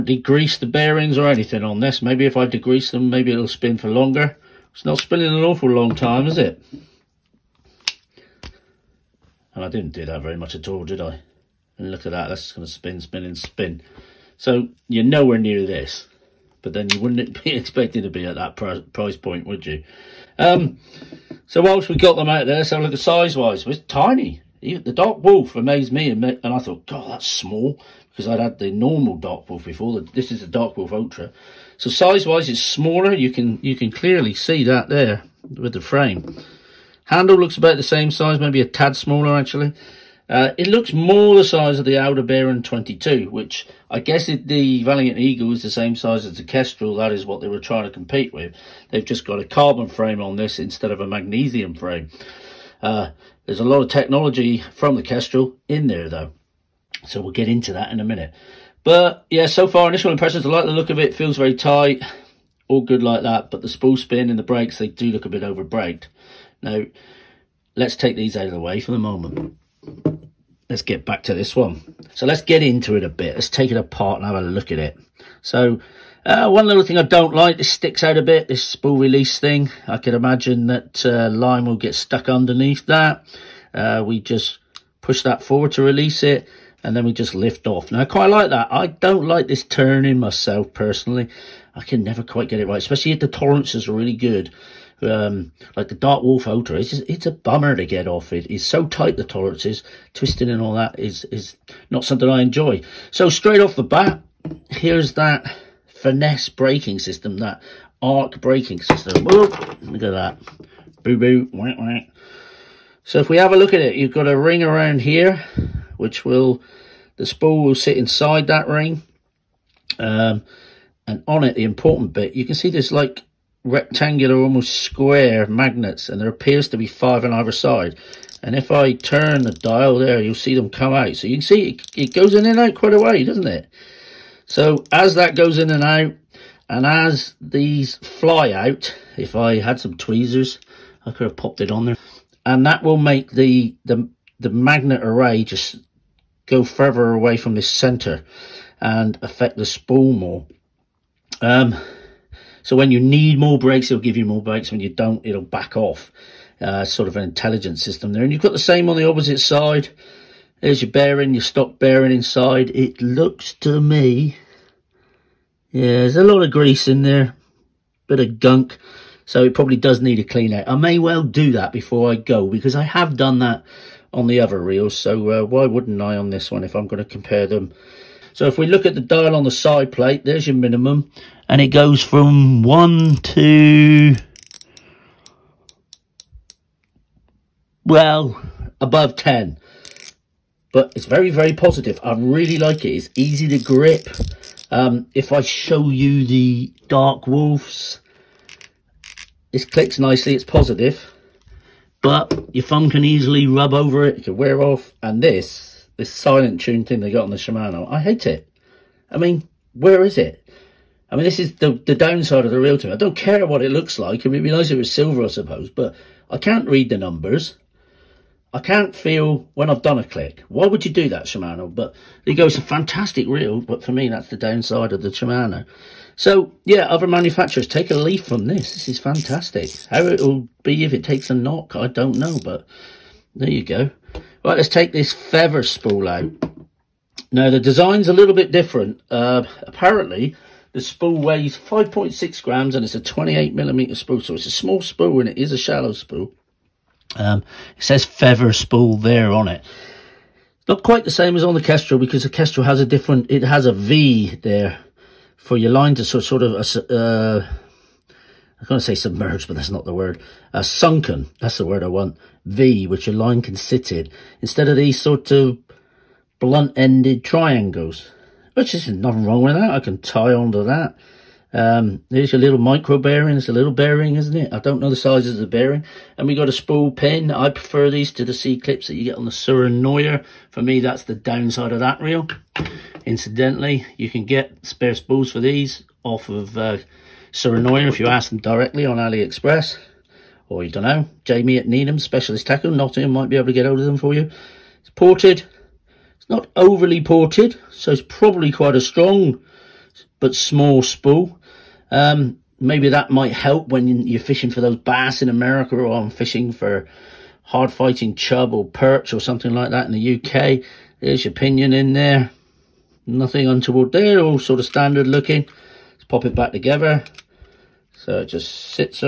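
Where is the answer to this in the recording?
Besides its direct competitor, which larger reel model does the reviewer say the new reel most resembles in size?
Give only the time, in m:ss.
0:41.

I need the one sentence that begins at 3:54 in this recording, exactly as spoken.
Right, let's take this feather spool out.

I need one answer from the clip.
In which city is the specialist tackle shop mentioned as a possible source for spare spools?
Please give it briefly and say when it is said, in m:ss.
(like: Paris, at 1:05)
Nottingham, at 4:52.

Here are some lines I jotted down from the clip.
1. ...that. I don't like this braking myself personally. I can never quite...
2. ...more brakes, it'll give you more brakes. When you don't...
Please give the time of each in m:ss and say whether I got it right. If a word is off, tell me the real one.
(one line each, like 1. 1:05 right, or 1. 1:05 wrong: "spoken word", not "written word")
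1. 1:28 wrong: "turning", not "braking"
2. 2:33 right.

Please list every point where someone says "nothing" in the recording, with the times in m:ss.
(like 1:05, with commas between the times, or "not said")
4:28, 5:13.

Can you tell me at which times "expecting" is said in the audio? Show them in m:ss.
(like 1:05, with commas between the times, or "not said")
0:17.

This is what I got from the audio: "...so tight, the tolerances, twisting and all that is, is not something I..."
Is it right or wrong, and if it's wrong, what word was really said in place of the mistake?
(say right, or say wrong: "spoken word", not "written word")
right.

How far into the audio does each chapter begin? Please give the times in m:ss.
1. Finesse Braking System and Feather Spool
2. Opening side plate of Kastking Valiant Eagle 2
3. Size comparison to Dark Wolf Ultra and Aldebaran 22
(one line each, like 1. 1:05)
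1. 1:46
2. 1:11
3. 0:22.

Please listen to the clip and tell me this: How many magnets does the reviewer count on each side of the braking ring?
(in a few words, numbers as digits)
5.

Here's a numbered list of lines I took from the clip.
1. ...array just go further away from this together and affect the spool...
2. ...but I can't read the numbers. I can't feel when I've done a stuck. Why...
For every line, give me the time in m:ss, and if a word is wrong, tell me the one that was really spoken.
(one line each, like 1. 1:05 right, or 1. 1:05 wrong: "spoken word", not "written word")
1. 2:25 wrong: "center", not "together"
2. 3:35 wrong: "click", not "stuck".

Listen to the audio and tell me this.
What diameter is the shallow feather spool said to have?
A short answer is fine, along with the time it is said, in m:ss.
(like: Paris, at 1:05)
28 millimeters, at 4:02.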